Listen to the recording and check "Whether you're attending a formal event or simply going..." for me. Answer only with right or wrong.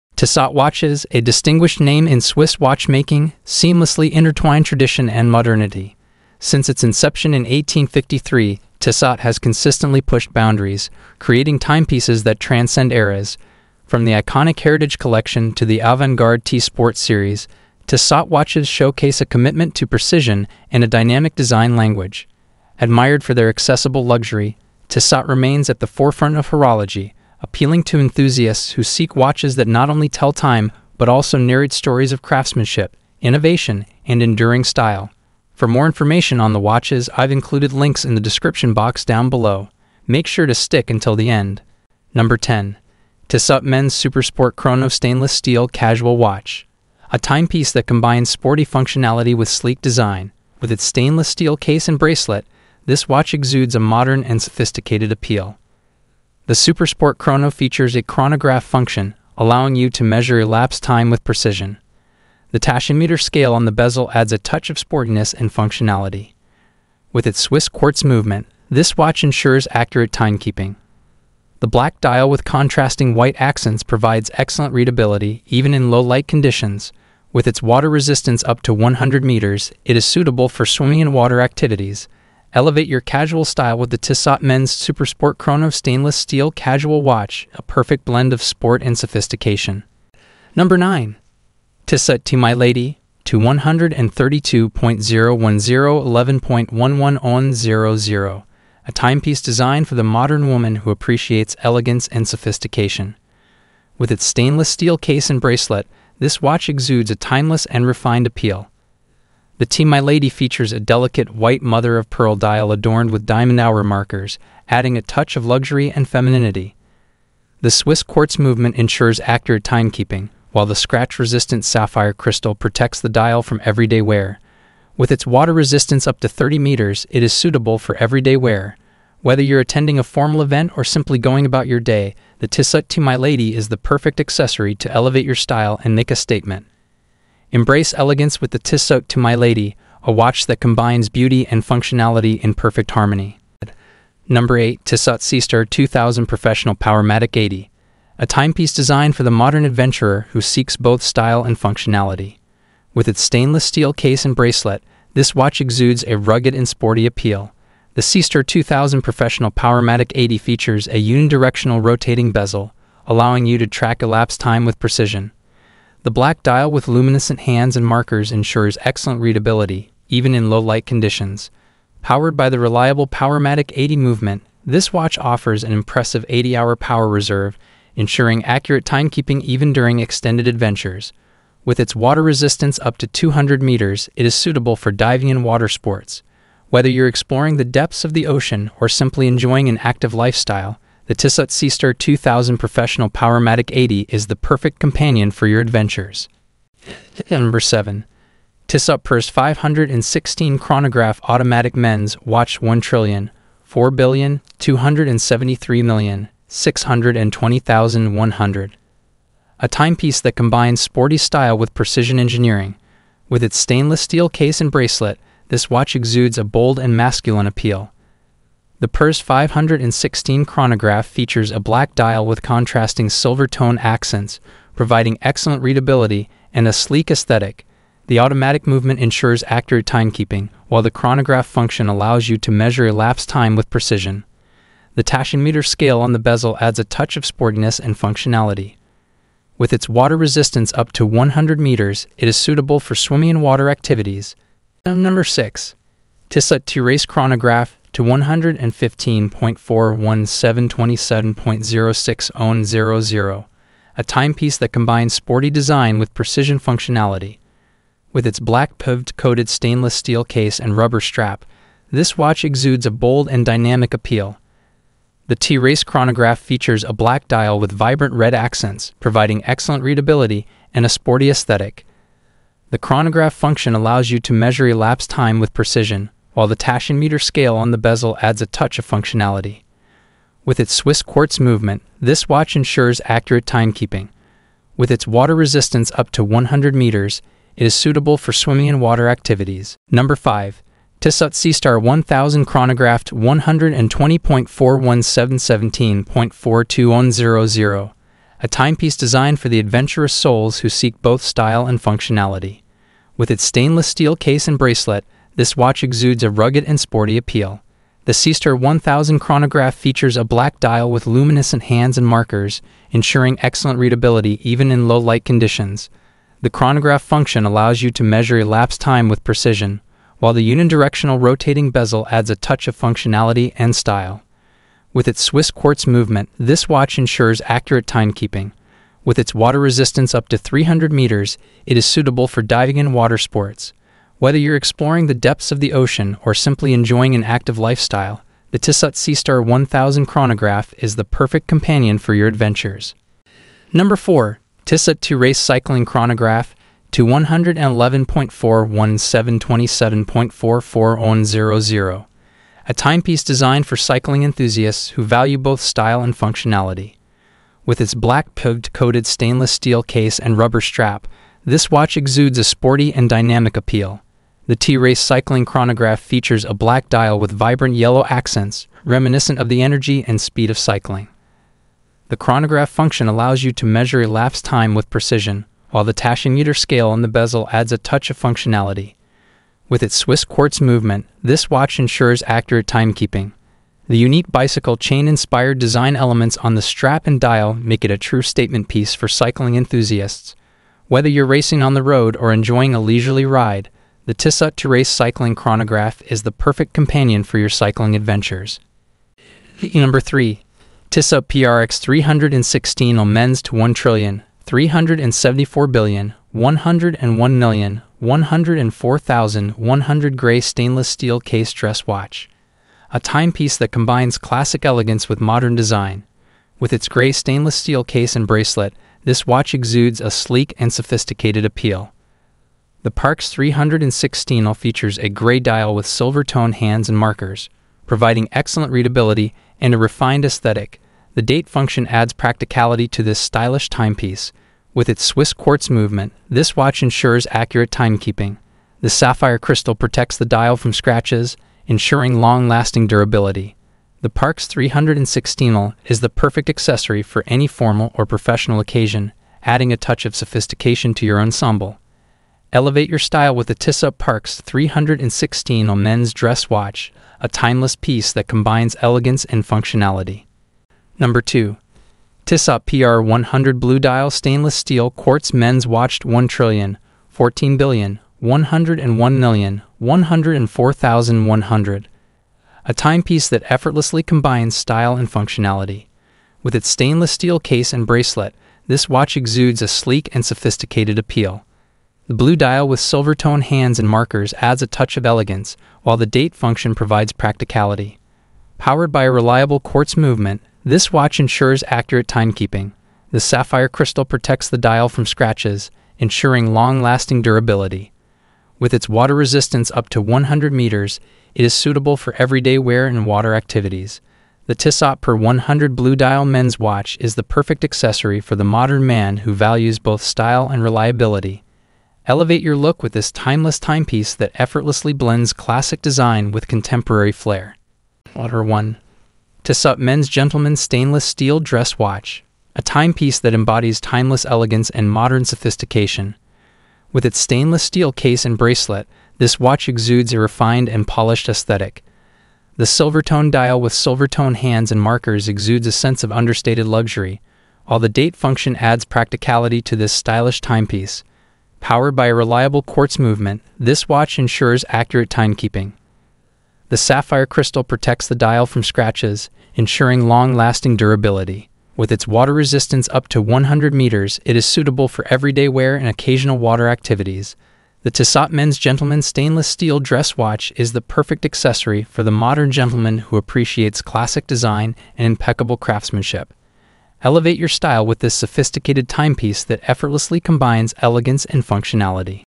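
right.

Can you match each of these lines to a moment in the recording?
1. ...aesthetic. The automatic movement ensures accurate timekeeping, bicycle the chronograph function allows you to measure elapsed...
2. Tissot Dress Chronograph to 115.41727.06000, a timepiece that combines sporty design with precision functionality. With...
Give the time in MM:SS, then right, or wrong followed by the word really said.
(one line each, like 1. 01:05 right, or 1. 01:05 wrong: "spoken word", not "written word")
1. 03:47 wrong: "while", not "bicycle"
2. 04:06 wrong: "Race", not "Dress".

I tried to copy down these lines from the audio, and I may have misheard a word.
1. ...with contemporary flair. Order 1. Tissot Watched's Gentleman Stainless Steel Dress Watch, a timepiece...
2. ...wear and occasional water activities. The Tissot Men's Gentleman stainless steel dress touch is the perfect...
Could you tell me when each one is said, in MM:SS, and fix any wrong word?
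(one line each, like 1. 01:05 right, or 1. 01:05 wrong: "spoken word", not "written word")
1. 08:36 wrong: "Men", not "Watched"
2. 09:15 wrong: "watch", not "touch".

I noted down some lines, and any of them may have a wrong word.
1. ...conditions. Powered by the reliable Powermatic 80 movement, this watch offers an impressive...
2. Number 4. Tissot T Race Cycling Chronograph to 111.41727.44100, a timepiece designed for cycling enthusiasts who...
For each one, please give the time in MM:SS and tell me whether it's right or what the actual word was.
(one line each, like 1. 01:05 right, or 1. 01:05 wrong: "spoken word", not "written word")
1. 02:50 right
2. 05:43 right.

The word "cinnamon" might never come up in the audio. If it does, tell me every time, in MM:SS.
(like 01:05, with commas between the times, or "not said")
not said.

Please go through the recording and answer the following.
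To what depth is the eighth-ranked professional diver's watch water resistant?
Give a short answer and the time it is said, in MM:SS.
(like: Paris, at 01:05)
200 meters, at 03:03.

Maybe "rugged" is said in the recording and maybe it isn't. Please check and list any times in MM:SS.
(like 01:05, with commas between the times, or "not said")
02:36, 05:06.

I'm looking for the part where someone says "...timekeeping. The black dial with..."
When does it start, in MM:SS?
01:10.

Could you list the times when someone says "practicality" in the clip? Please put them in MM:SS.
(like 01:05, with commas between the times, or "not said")
07:12, 08:07, 08:58.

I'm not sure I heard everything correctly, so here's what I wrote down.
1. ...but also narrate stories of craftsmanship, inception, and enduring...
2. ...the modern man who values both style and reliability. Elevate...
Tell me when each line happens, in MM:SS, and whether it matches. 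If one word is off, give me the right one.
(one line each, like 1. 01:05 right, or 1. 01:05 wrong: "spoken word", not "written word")
1. 00:30 wrong: "innovation", not "inception"
2. 08:28 right.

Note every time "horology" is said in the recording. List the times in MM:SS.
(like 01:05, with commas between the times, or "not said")
00:26.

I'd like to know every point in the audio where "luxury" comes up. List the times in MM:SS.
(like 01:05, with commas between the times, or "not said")
00:24, 01:55, 08:56.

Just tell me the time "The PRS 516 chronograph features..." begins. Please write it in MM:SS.
03:38.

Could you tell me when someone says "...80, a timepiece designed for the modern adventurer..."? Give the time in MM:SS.
02:27.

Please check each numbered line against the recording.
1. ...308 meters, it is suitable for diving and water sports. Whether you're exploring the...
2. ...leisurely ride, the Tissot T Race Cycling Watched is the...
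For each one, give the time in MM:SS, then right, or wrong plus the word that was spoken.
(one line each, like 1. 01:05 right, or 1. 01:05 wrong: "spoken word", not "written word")
1. 05:30 wrong: "300", not "308"
2. 06:32 wrong: "Chronograph", not "Watched".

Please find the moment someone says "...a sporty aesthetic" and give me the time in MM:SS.
04:30.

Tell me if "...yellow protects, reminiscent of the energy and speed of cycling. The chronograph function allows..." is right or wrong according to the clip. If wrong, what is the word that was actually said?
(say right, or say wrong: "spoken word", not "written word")
wrong: "accents", not "protects".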